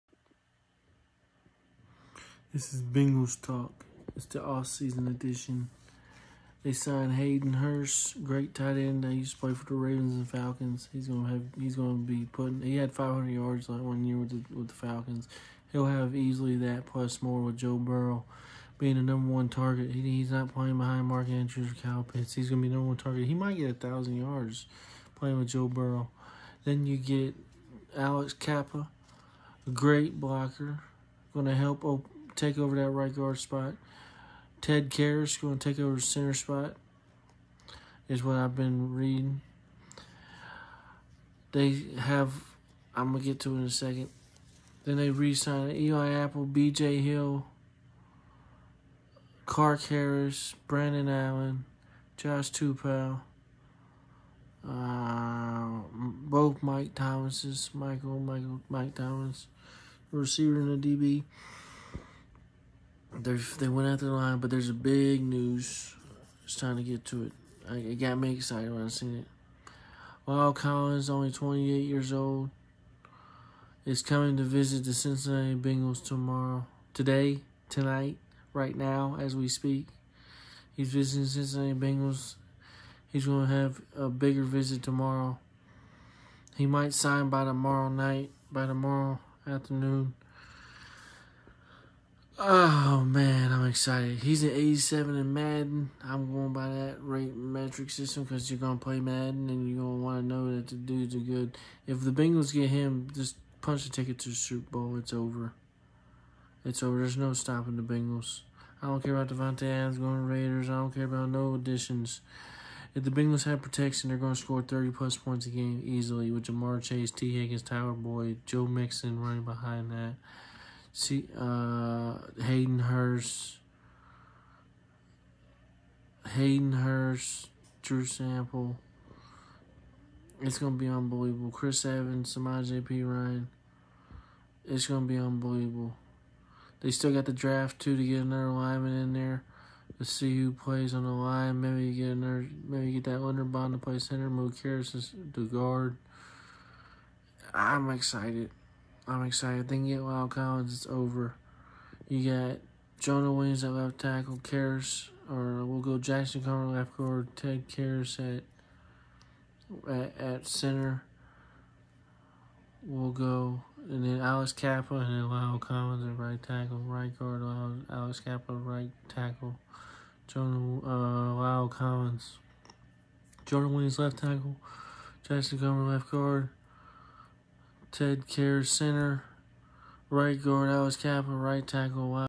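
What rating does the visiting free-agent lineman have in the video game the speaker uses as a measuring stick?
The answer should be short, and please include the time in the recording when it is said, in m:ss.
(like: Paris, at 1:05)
87, at 1:34.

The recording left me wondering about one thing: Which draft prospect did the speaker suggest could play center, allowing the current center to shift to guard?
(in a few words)
Linderbaum.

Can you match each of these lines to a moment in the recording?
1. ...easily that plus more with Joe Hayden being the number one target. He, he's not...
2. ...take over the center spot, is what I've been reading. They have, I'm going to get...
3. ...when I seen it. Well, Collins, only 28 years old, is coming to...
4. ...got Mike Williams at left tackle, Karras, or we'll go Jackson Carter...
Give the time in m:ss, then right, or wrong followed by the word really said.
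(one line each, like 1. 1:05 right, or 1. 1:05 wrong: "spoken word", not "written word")
1. 0:16 wrong: "Burrow", not "Hayden"
2. 0:35 right
3. 1:08 right
4. 2:32 wrong: "Jonah", not "Mike".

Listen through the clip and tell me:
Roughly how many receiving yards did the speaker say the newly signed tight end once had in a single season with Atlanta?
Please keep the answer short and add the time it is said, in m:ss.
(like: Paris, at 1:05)
500, at 0:12.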